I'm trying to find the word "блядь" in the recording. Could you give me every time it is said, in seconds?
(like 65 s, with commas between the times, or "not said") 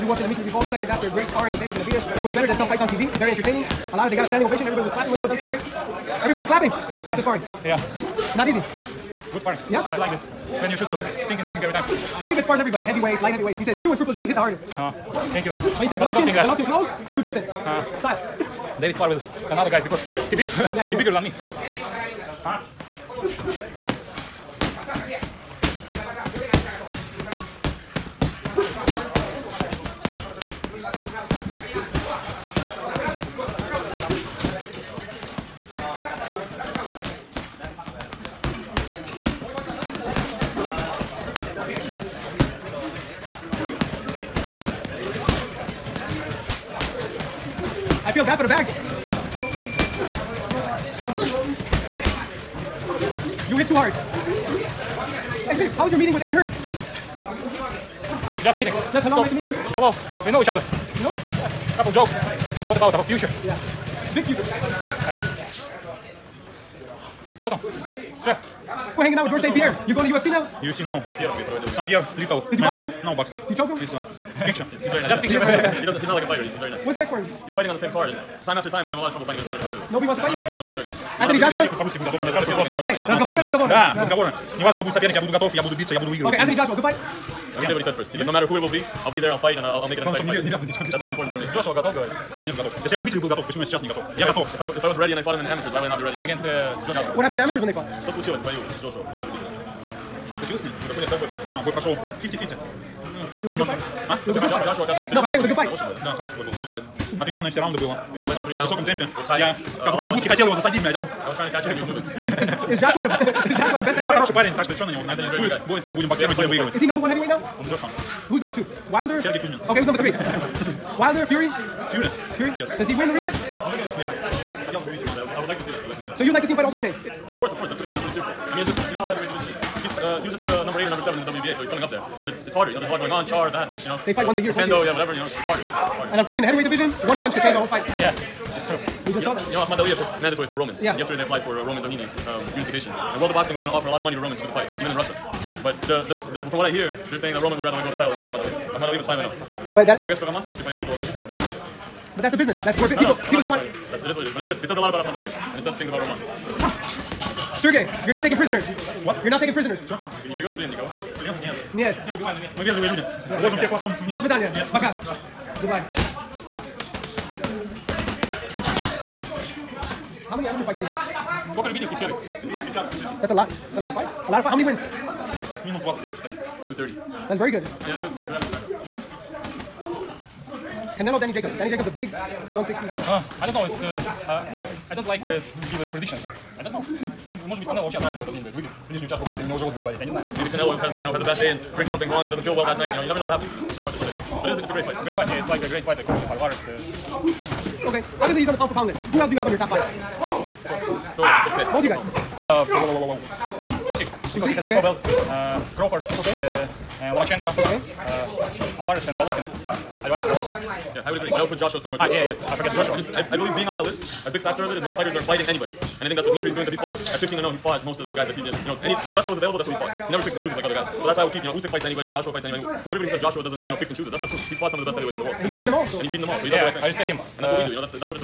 110 s, 188 s.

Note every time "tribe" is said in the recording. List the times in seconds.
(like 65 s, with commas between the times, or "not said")
not said.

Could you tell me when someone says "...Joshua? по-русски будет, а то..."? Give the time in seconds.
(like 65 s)
81 s.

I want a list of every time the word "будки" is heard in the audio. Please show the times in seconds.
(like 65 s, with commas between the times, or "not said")
110 s.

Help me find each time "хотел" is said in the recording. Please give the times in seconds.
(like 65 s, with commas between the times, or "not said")
110 s.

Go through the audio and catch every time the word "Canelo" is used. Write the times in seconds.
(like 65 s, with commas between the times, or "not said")
180 s, 190 s.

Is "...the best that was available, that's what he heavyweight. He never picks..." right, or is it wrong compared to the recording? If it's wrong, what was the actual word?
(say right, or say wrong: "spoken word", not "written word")
wrong: "fought", not "heavyweight".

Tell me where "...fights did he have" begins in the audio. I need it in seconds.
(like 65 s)
170 s.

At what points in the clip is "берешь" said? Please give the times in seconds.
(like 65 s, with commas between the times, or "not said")
160 s.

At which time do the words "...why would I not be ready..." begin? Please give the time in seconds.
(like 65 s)
95 s.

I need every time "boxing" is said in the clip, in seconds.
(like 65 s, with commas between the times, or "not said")
73 s, 143 s.